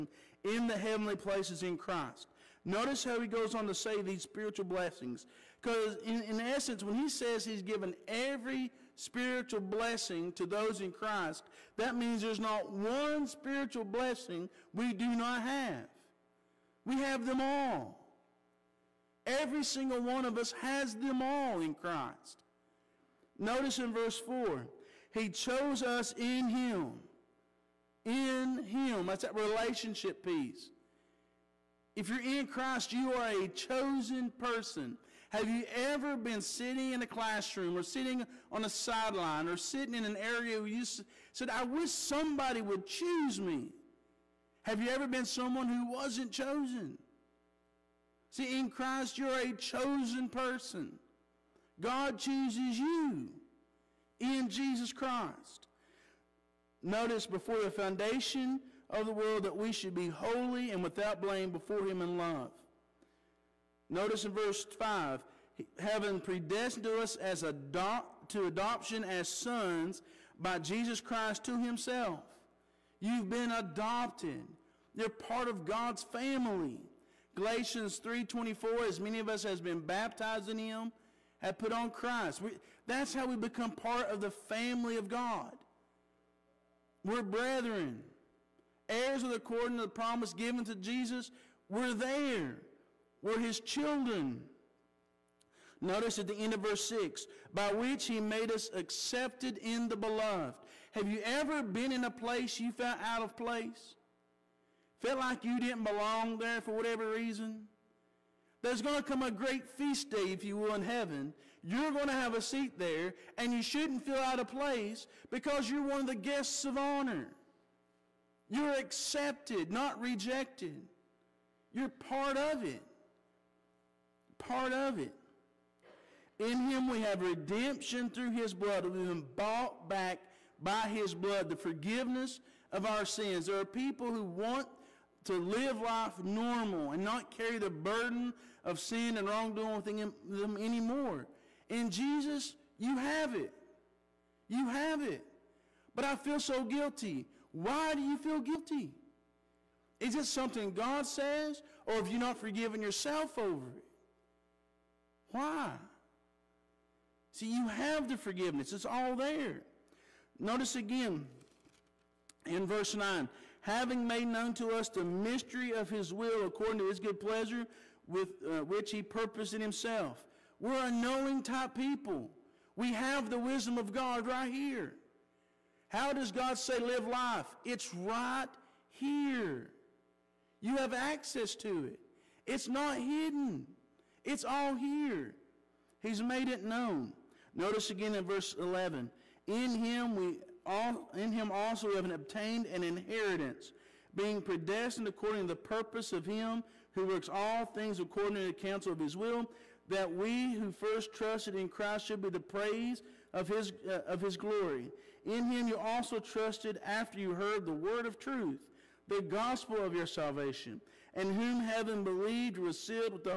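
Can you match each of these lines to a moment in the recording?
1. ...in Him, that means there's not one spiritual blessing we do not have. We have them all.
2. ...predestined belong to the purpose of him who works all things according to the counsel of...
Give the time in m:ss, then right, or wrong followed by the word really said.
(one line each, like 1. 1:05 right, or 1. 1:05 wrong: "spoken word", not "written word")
1. 0:10 wrong: "Christ", not "Him"
2. 3:14 wrong: "according", not "belong".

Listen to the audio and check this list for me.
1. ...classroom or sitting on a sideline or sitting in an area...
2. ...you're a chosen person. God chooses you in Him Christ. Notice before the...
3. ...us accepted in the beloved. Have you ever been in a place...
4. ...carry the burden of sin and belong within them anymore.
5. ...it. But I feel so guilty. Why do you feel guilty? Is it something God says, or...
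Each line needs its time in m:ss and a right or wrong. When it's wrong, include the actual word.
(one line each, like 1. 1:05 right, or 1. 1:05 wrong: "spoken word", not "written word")
1. 0:37 right
2. 0:49 wrong: "Jesus", not "Him"
3. 1:38 right
4. 2:17 wrong: "wrongdoing", not "belong"
5. 2:25 right.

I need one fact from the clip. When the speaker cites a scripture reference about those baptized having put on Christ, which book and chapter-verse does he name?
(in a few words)
Galatians 3:24.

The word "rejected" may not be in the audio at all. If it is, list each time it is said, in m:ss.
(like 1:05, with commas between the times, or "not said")
2:00.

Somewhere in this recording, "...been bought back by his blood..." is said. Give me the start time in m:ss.
2:08.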